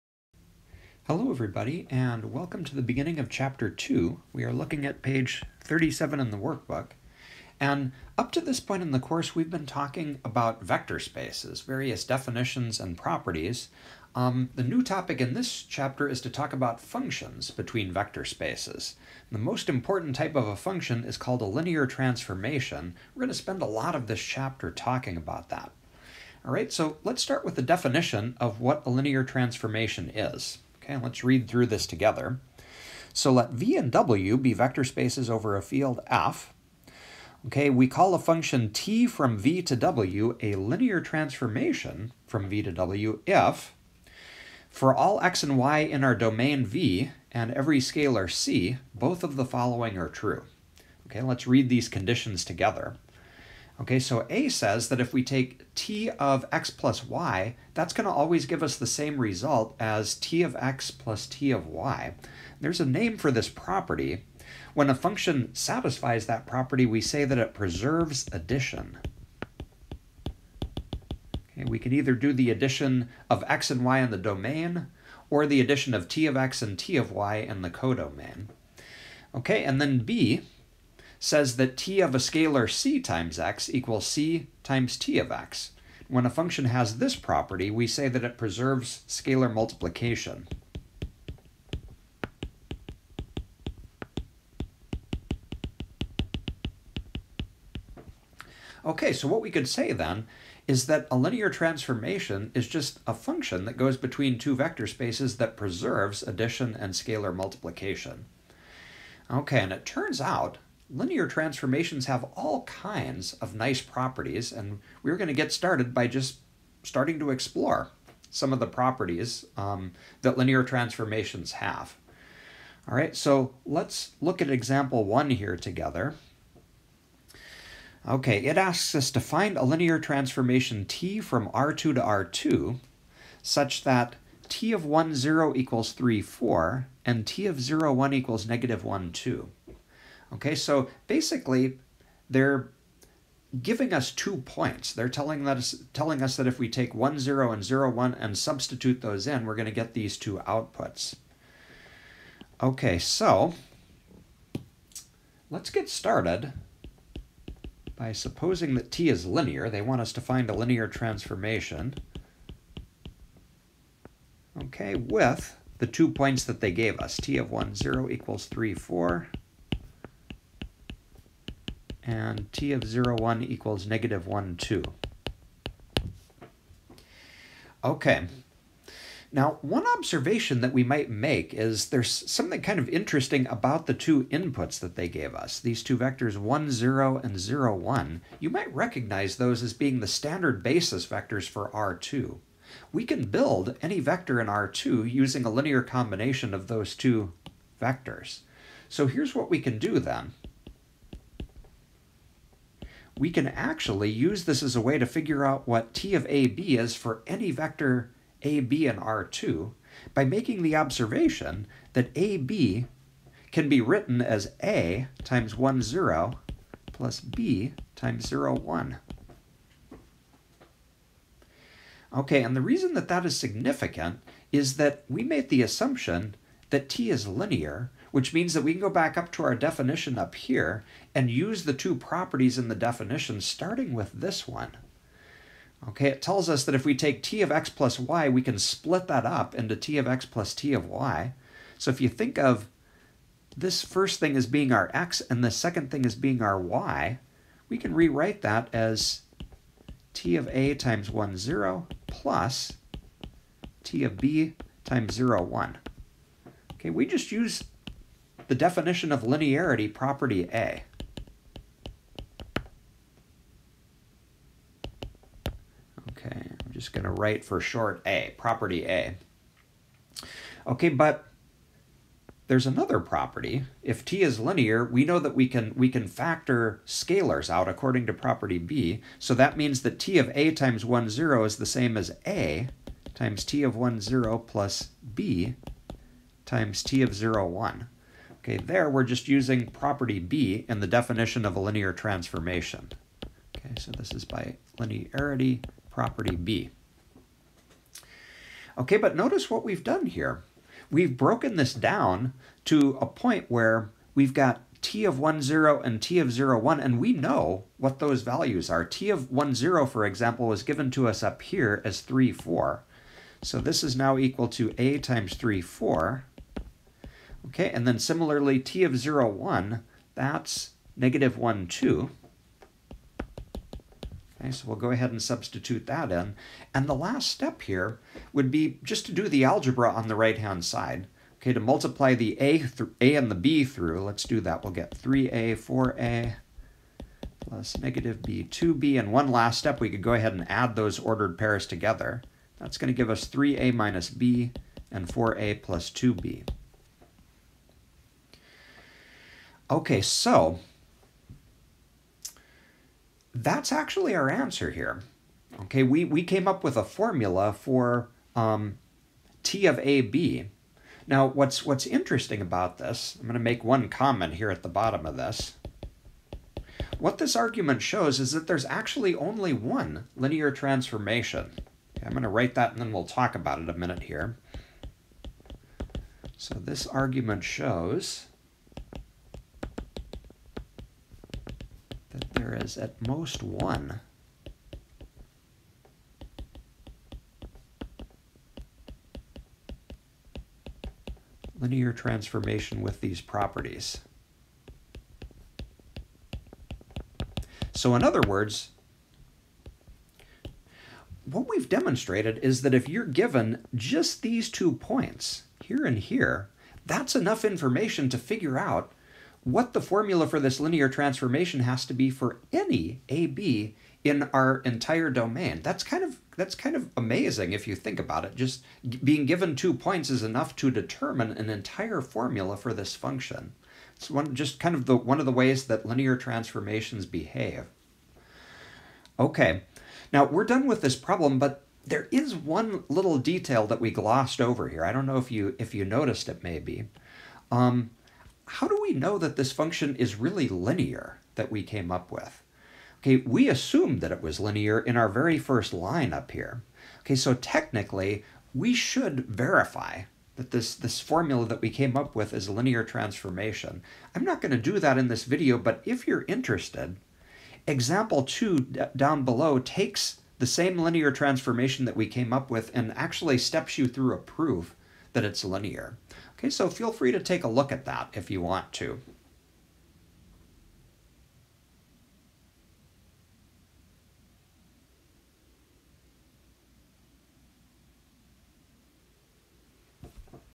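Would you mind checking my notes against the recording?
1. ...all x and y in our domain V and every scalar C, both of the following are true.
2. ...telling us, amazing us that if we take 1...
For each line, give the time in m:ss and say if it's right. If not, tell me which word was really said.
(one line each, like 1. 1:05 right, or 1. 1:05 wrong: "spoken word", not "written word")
1. 0:44 right
2. 2:25 wrong: "telling", not "amazing".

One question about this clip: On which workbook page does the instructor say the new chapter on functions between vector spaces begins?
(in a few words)
37.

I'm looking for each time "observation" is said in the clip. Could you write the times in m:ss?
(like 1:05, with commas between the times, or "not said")
2:59, 3:30.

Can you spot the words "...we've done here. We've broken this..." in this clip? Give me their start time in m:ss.
4:59.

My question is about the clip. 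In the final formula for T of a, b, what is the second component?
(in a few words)
4a plus 2b.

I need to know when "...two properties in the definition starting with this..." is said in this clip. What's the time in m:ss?
3:51.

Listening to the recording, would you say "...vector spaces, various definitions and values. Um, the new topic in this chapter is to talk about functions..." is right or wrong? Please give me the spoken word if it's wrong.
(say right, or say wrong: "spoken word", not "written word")
wrong: "properties", not "values".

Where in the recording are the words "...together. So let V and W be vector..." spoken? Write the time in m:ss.
0:31.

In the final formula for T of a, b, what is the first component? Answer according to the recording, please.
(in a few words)
3a minus b.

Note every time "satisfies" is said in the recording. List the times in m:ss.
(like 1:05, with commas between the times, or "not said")
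1:05.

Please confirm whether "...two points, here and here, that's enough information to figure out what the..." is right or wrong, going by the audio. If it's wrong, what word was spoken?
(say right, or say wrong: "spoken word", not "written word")
right.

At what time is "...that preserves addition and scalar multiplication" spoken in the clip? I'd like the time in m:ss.
1:45.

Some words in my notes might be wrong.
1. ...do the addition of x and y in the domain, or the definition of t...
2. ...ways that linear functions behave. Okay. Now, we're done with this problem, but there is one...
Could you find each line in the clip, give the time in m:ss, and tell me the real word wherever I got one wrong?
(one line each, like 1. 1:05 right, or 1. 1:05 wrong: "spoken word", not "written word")
1. 1:12 wrong: "addition", not "definition"
2. 7:05 wrong: "transformations", not "functions".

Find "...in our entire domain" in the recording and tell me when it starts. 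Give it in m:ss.
6:54.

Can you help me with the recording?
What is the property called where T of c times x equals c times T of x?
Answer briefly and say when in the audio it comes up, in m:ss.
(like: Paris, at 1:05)
preserves scalar multiplication, at 1:28.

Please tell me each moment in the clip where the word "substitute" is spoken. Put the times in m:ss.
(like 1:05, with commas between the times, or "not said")
2:28, 5:25.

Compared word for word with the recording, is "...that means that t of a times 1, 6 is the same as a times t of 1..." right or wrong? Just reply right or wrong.
wrong.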